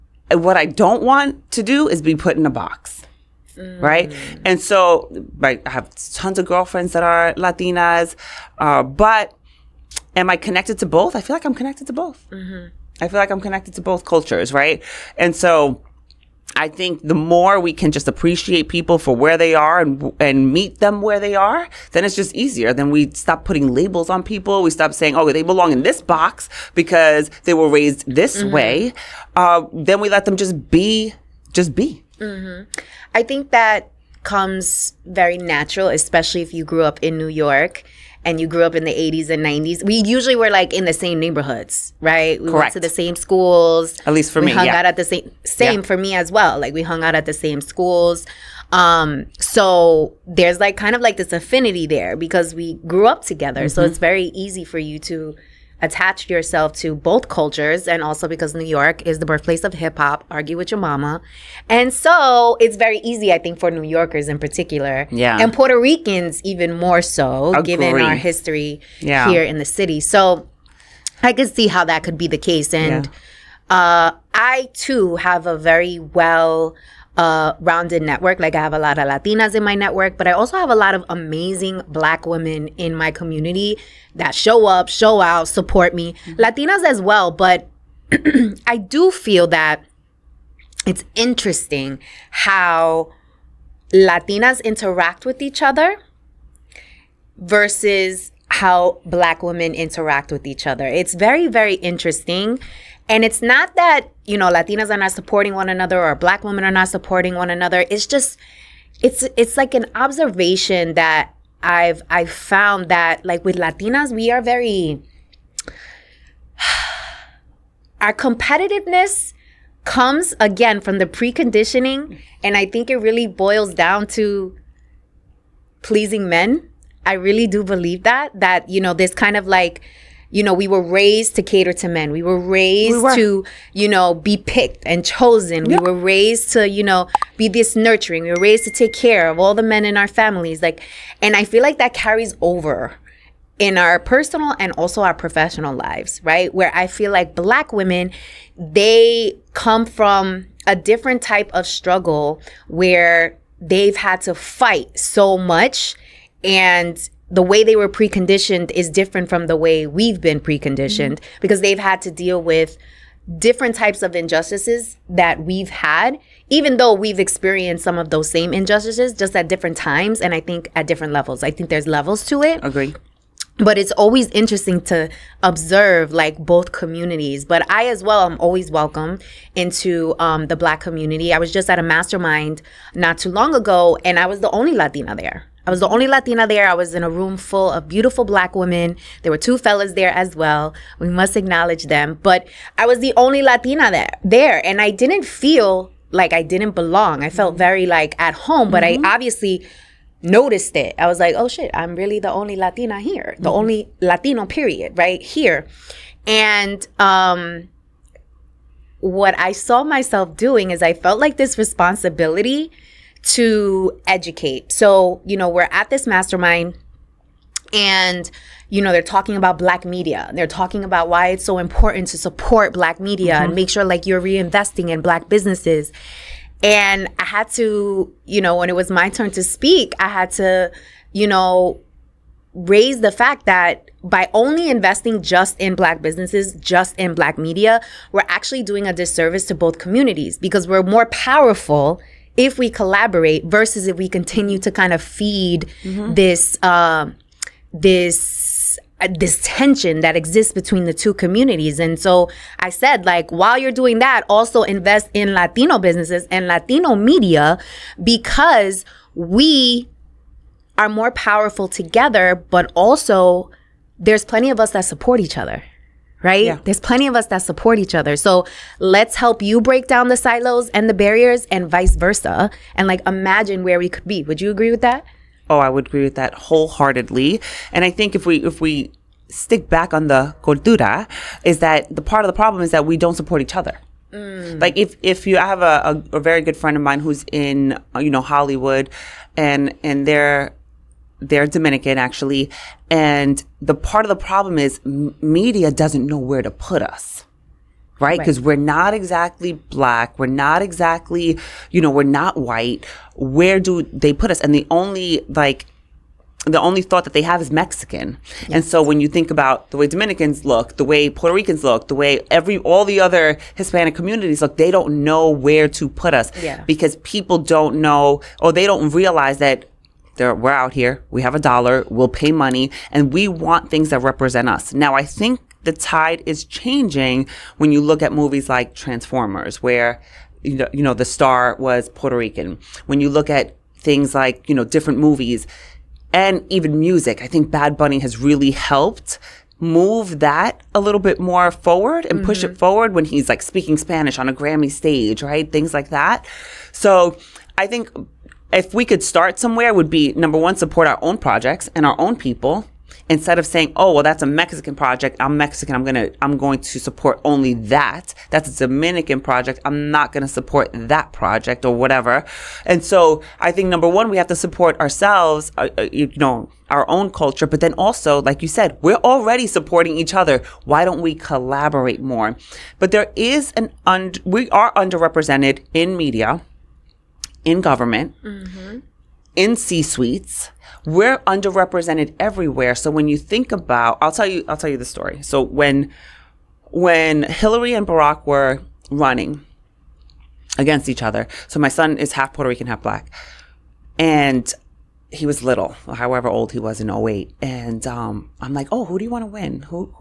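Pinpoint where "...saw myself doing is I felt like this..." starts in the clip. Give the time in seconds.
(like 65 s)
209 s.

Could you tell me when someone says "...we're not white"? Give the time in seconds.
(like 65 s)
301 s.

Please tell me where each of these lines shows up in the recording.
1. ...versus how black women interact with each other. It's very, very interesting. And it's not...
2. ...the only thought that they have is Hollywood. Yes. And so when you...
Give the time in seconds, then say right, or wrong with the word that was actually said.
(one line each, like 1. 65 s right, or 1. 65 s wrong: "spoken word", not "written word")
1. 97 s right
2. 306 s wrong: "Mexican", not "Hollywood".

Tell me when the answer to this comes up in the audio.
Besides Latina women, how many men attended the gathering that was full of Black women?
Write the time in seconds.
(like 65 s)
189 s.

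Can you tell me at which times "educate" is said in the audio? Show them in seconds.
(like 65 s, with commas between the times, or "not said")
214 s.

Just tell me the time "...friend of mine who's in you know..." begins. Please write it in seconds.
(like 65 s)
286 s.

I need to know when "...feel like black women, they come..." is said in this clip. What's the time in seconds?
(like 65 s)
146 s.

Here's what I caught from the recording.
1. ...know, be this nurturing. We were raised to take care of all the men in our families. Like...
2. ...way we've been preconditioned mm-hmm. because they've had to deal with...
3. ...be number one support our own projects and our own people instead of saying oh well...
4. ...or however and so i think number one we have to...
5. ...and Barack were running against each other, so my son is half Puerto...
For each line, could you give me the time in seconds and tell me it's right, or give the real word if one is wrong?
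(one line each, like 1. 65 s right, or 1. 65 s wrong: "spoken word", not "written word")
1. 136 s right
2. 159 s right
3. 349 s right
4. 361 s wrong: "whatever", not "however"
5. 387 s right.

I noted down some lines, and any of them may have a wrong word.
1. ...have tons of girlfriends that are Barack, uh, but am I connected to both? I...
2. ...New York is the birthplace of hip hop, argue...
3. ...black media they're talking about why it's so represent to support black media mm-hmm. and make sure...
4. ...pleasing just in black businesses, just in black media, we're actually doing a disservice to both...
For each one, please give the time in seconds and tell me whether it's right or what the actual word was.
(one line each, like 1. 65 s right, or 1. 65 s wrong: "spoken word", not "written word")
1. 5 s wrong: "Latinas", not "Barack"
2. 58 s right
3. 219 s wrong: "important", not "represent"
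4. 234 s wrong: "investing", not "pleasing".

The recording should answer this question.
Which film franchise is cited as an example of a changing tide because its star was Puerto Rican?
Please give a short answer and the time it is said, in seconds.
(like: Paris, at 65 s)
Transformers, at 328 s.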